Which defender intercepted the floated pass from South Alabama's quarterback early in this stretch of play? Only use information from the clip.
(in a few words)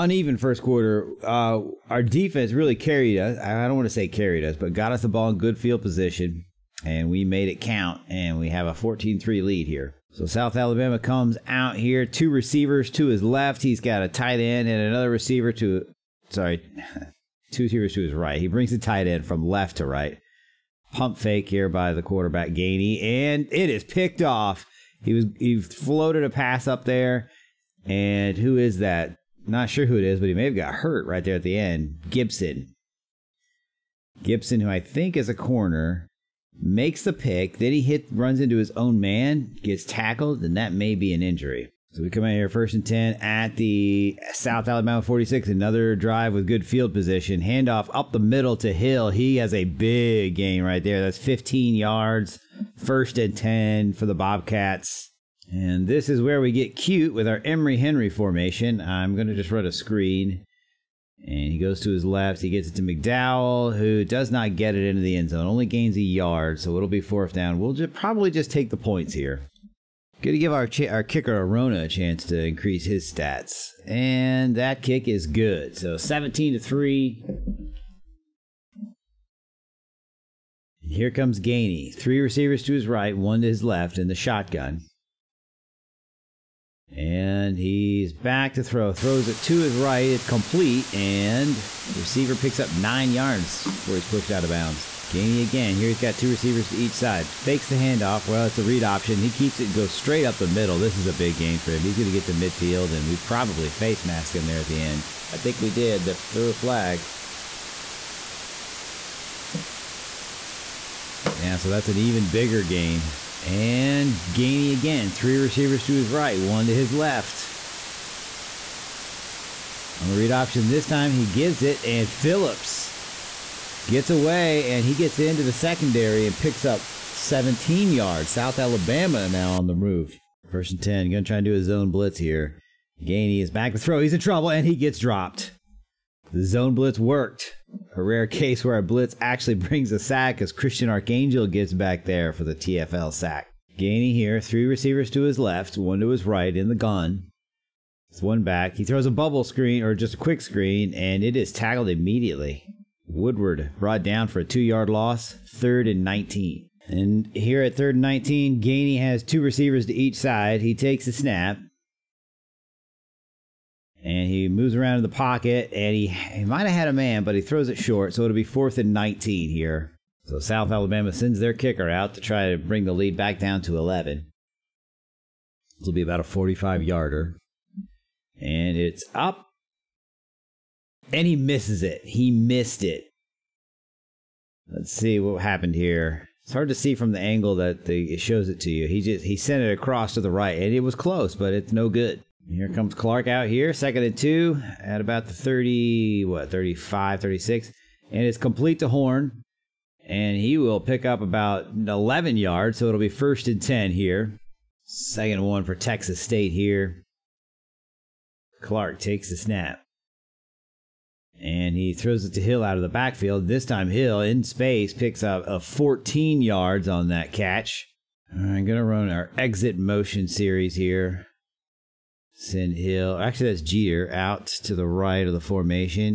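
Gibson.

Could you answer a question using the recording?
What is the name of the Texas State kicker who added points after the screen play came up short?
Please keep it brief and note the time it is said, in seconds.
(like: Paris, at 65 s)
Arona, at 71 s.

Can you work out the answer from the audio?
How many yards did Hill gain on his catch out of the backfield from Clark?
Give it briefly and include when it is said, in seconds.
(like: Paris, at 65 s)
14, at 215 s.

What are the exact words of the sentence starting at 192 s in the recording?
Here comes Clark out here, second and two at about the 30, what, 35, 36.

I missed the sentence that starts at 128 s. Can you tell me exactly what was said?
South Alabama now on the move.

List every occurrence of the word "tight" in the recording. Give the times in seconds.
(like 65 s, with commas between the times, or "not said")
14 s, 18 s.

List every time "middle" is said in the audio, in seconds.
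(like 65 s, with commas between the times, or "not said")
48 s, 100 s.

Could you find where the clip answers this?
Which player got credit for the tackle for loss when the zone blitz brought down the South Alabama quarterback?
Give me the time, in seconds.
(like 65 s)
140 s.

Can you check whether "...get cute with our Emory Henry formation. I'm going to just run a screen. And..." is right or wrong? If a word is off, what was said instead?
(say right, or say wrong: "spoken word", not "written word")
right.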